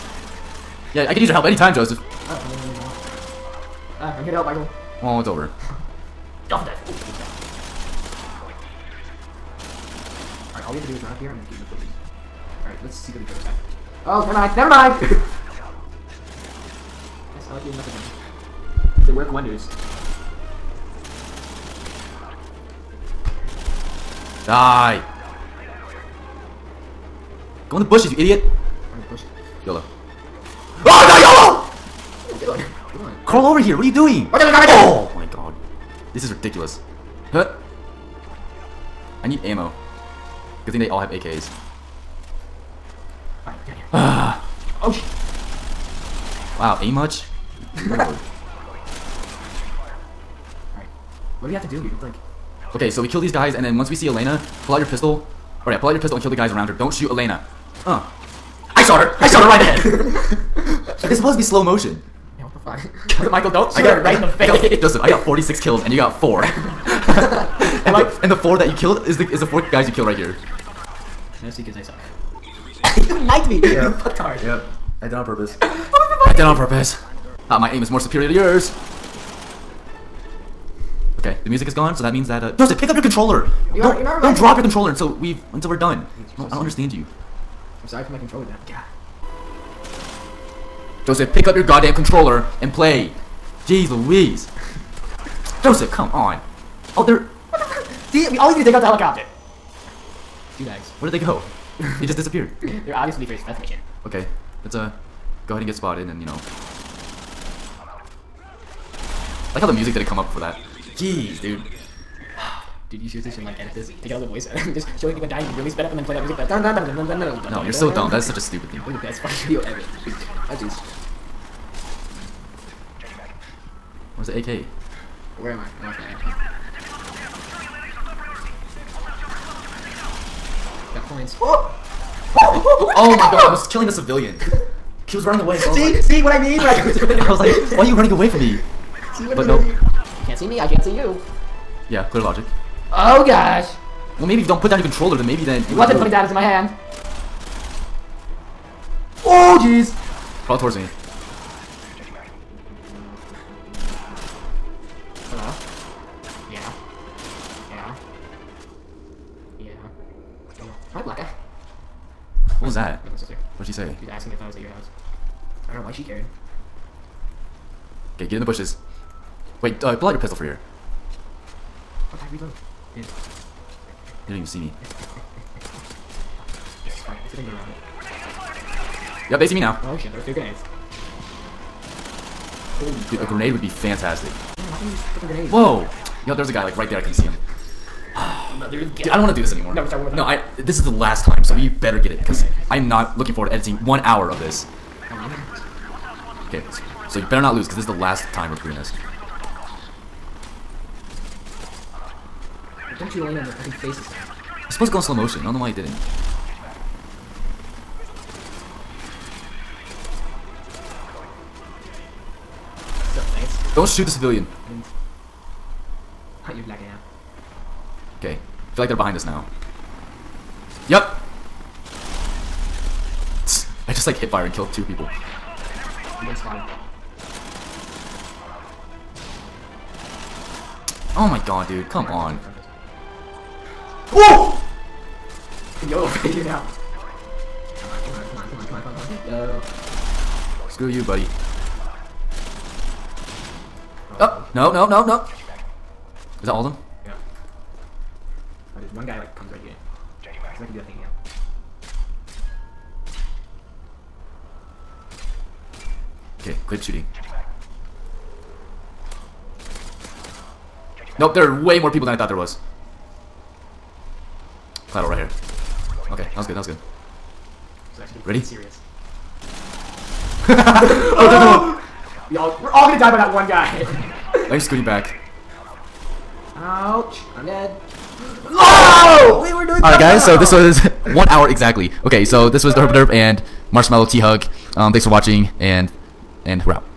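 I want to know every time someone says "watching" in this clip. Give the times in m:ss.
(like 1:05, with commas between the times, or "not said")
4:45.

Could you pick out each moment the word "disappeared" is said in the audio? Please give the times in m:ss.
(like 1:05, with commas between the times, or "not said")
1:42.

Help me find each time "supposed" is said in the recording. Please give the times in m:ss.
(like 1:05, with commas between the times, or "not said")
1:01, 3:24.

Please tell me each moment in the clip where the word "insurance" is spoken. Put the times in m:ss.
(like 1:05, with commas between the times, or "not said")
not said.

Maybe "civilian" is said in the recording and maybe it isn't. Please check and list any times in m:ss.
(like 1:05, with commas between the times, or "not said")
2:13, 3:34.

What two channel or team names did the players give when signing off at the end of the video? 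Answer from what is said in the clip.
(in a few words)
Herpaderp and Marshmellowthug.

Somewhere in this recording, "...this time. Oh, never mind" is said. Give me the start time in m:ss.
0:13.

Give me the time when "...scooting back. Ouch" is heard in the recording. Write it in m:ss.
4:34.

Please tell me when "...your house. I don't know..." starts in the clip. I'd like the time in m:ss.
2:44.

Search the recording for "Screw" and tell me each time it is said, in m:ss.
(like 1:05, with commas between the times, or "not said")
4:00.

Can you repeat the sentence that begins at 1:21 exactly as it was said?
Okay, the music is gone, so that means that uh, Joseph, pick up your controller.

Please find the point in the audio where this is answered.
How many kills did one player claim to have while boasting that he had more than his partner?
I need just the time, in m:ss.
1:05.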